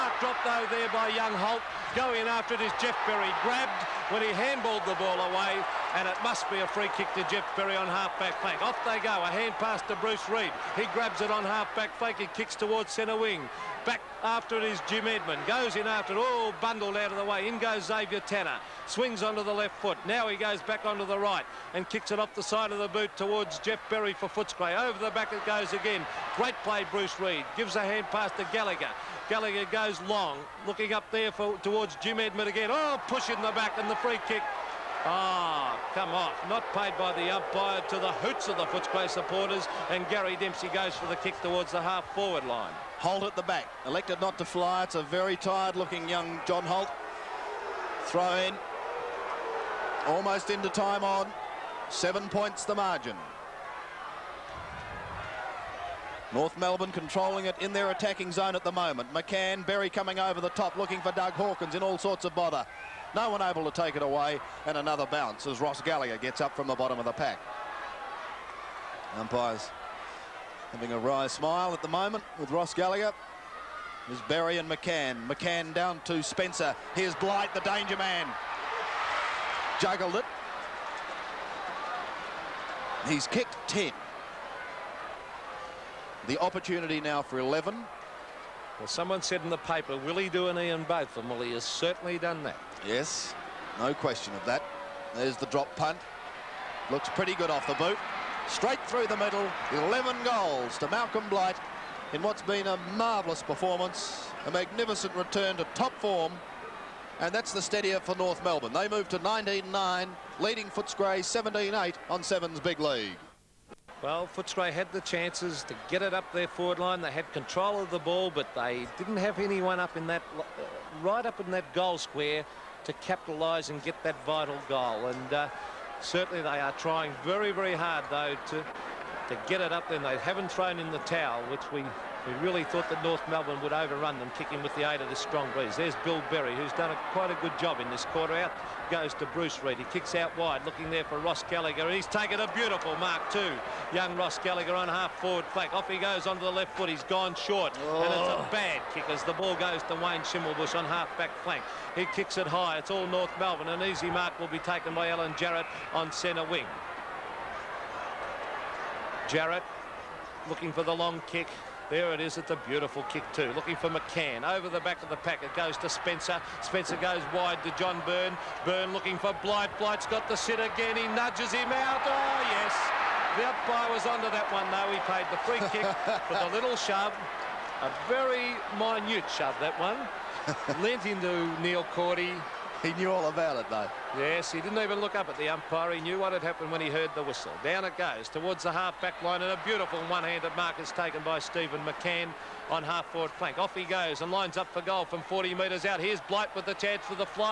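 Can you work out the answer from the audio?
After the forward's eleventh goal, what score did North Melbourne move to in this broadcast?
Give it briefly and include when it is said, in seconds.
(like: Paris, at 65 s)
19-9, at 109 s.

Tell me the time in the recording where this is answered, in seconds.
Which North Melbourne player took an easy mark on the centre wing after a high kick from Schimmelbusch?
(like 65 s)
155 s.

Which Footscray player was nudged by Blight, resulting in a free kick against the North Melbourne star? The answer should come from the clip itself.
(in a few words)
Neil Cordy.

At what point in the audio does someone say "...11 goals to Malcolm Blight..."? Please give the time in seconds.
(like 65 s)
99 s.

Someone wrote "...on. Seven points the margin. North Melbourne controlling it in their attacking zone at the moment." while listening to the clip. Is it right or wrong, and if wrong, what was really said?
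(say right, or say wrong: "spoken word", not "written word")
right.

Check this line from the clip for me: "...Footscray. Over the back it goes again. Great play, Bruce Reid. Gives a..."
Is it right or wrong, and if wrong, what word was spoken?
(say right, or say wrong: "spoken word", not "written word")
right.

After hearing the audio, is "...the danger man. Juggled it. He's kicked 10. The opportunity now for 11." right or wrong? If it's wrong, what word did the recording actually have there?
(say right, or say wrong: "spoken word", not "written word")
right.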